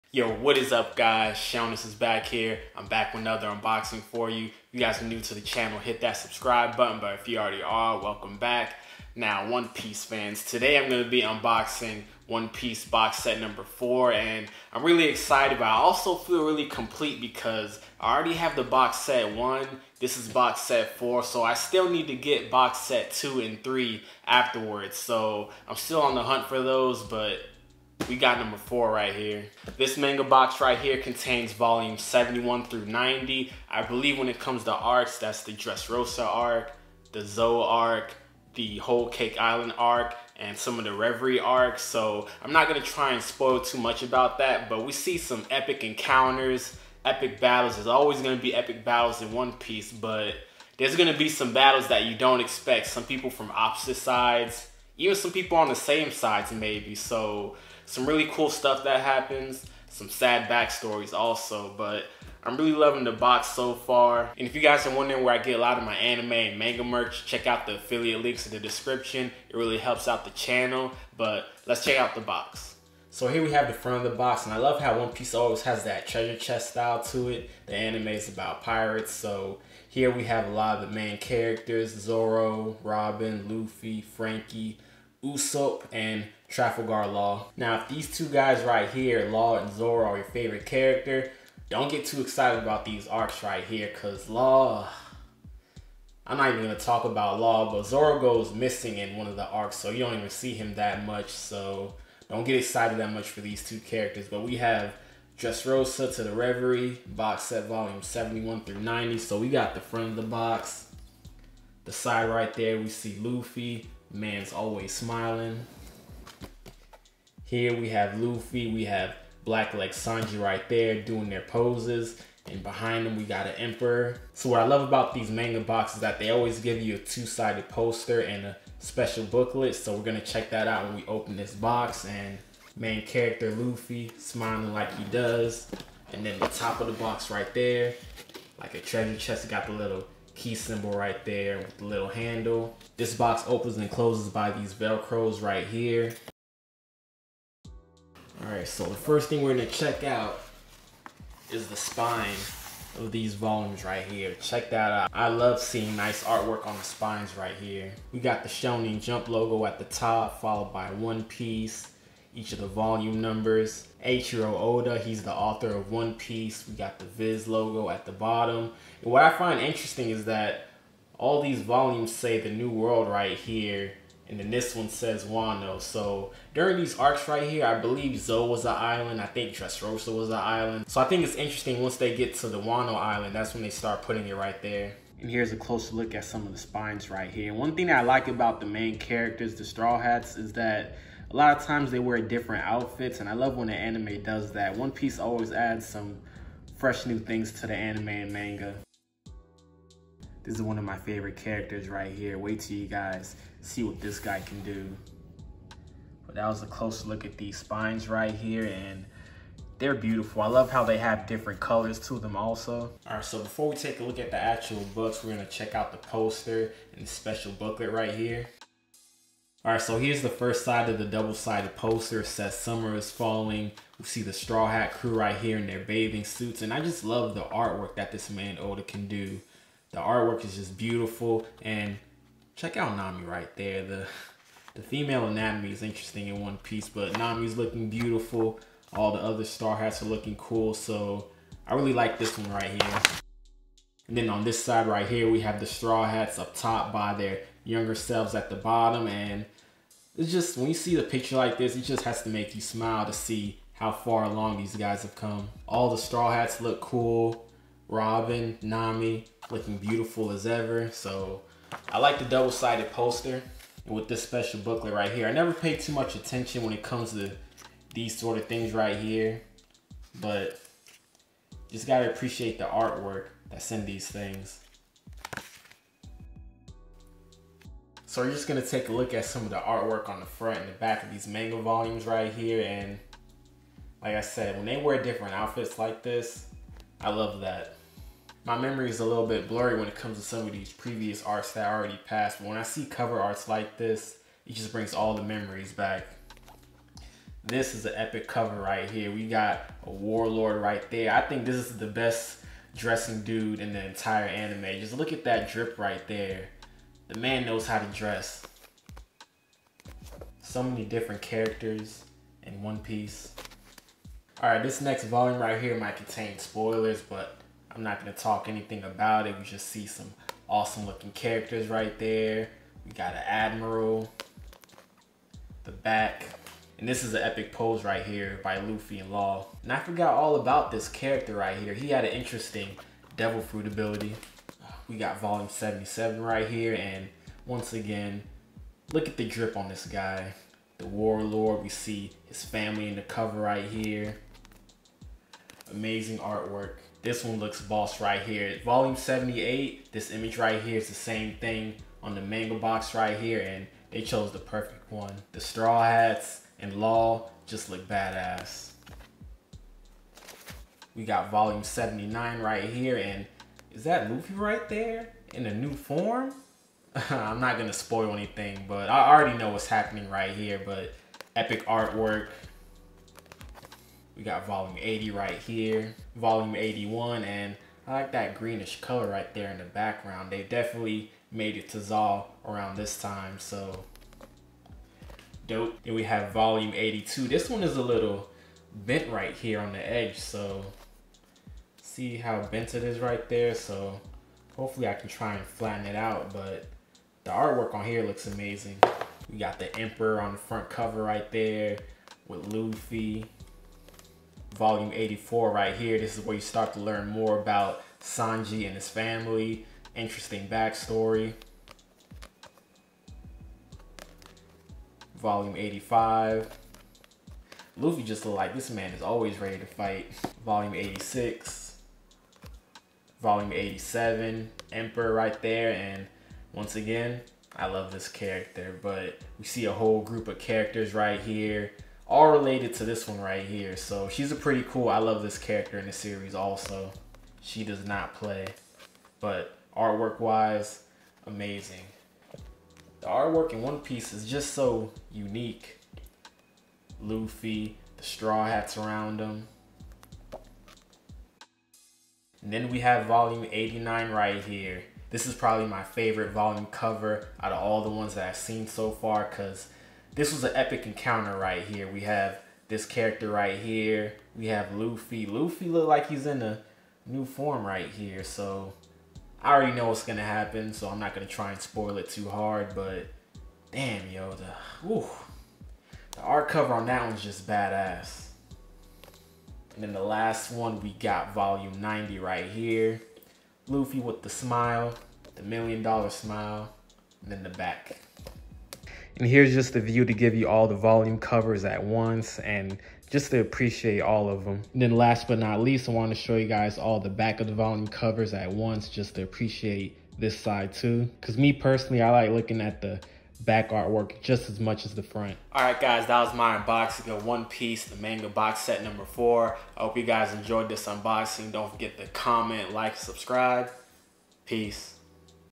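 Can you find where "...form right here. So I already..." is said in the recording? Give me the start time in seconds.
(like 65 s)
467 s.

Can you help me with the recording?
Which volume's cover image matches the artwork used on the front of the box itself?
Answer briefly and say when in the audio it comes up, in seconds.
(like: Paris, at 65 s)
78, at 348 s.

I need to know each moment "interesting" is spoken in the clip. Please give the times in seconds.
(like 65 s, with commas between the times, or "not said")
169 s, 181 s, 235 s, 332 s, 409 s.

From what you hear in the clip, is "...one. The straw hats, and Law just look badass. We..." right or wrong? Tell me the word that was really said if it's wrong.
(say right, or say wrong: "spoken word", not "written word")
right.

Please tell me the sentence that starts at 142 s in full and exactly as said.
This box opens and closes by these Velcros right here.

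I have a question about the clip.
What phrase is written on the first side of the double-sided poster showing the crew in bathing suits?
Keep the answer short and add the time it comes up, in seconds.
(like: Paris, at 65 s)
Summer is falling, at 222 s.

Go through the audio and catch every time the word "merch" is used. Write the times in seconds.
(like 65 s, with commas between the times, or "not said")
66 s.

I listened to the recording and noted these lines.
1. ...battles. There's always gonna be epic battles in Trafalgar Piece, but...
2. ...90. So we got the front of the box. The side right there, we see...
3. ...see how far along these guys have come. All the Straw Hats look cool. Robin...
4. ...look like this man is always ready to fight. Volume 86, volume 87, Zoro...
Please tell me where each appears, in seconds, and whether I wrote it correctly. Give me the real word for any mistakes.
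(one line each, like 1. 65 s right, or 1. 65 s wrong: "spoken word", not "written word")
1. 47 s wrong: "One", not "Trafalgar"
2. 108 s right
3. 253 s right
4. 418 s wrong: "Emperor", not "Zoro".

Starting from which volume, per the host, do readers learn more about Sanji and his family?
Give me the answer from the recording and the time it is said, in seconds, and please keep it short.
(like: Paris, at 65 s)
84, at 404 s.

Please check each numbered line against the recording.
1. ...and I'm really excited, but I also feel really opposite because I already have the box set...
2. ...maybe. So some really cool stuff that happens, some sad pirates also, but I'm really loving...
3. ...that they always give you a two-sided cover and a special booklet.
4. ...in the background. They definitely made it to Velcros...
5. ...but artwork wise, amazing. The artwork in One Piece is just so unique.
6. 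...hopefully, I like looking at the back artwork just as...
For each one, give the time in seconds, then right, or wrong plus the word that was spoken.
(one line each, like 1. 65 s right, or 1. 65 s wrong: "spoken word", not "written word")
1. 14 s wrong: "complete", not "opposite"
2. 56 s wrong: "backstories", not "pirates"
3. 126 s wrong: "poster", not "cover"
4. 379 s wrong: "Zou", not "Velcros"
5. 439 s right
6. 501 s wrong: "personally", not "hopefully".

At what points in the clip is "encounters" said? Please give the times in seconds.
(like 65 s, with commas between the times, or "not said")
45 s, 460 s.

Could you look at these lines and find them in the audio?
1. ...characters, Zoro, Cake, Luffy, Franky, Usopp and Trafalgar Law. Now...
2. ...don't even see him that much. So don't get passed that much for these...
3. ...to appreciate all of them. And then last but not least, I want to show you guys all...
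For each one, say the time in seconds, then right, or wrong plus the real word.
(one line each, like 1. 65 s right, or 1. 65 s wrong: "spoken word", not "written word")
1. 81 s wrong: "Robin", not "Cake"
2. 99 s wrong: "excited", not "passed"
3. 493 s right.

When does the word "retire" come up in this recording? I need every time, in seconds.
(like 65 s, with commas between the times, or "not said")
not said.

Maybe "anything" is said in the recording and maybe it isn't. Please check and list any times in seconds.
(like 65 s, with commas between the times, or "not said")
318 s, 368 s.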